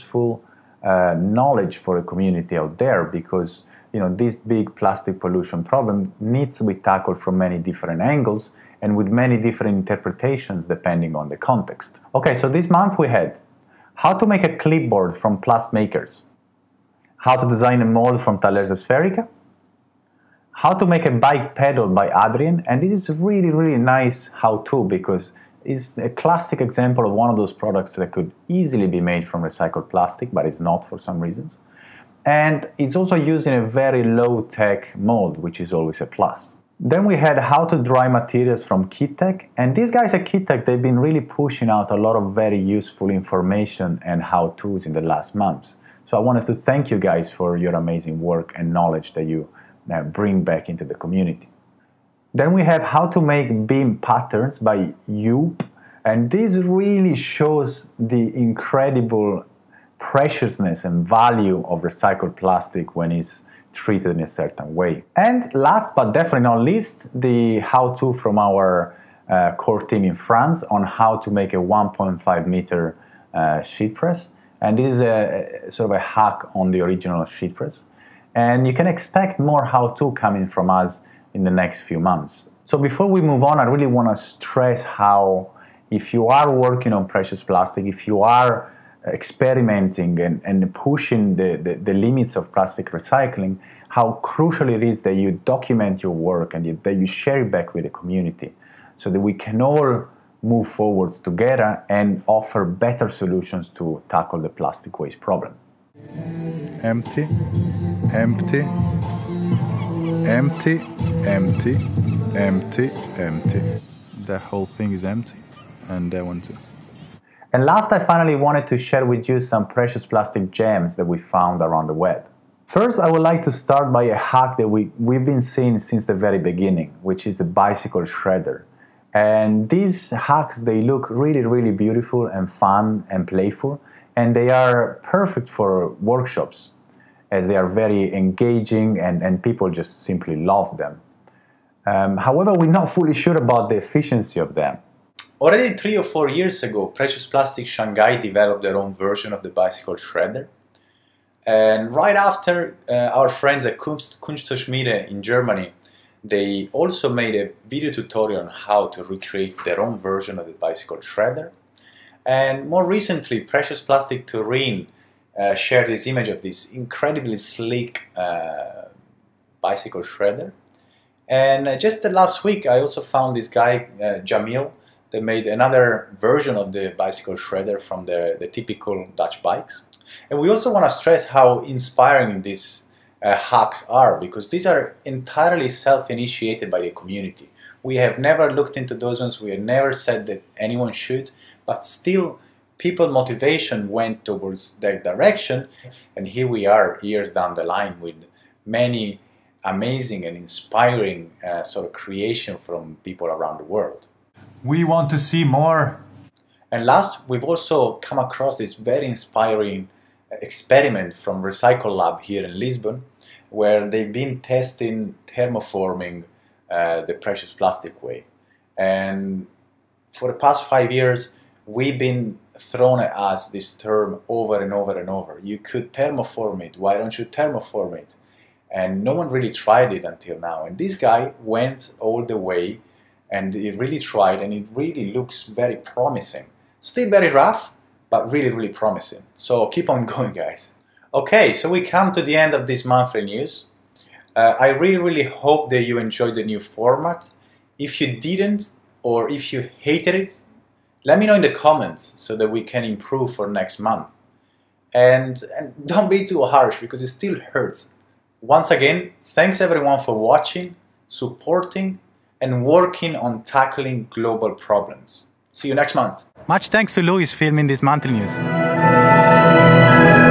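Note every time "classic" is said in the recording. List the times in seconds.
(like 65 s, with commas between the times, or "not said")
26 s.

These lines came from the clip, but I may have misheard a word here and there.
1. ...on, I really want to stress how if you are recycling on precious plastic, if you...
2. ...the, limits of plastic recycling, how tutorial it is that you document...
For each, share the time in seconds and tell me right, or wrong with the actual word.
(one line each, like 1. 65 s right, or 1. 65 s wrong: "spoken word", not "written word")
1. 83 s wrong: "working", not "recycling"
2. 91 s wrong: "crucial", not "tutorial".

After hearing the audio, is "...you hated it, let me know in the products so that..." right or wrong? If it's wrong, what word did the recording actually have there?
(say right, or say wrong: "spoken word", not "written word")
wrong: "comments", not "products".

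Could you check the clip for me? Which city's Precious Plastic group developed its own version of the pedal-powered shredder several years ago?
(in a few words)
Shanghai.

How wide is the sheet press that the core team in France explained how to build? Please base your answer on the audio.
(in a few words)
1.5 meters.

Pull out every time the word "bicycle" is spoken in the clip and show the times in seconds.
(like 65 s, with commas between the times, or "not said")
127 s, 149 s, 160 s, 169 s, 176 s.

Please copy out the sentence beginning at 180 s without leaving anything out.
And we also want to stress how inspiring these uh, hacks are because these are entirely self-initiated by the community.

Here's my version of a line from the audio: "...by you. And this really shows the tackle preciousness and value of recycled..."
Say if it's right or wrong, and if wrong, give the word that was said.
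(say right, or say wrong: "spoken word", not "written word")
wrong: "incredible", not "tackle".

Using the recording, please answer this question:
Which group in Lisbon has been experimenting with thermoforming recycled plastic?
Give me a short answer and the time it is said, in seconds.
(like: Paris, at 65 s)
Recycle Lab, at 211 s.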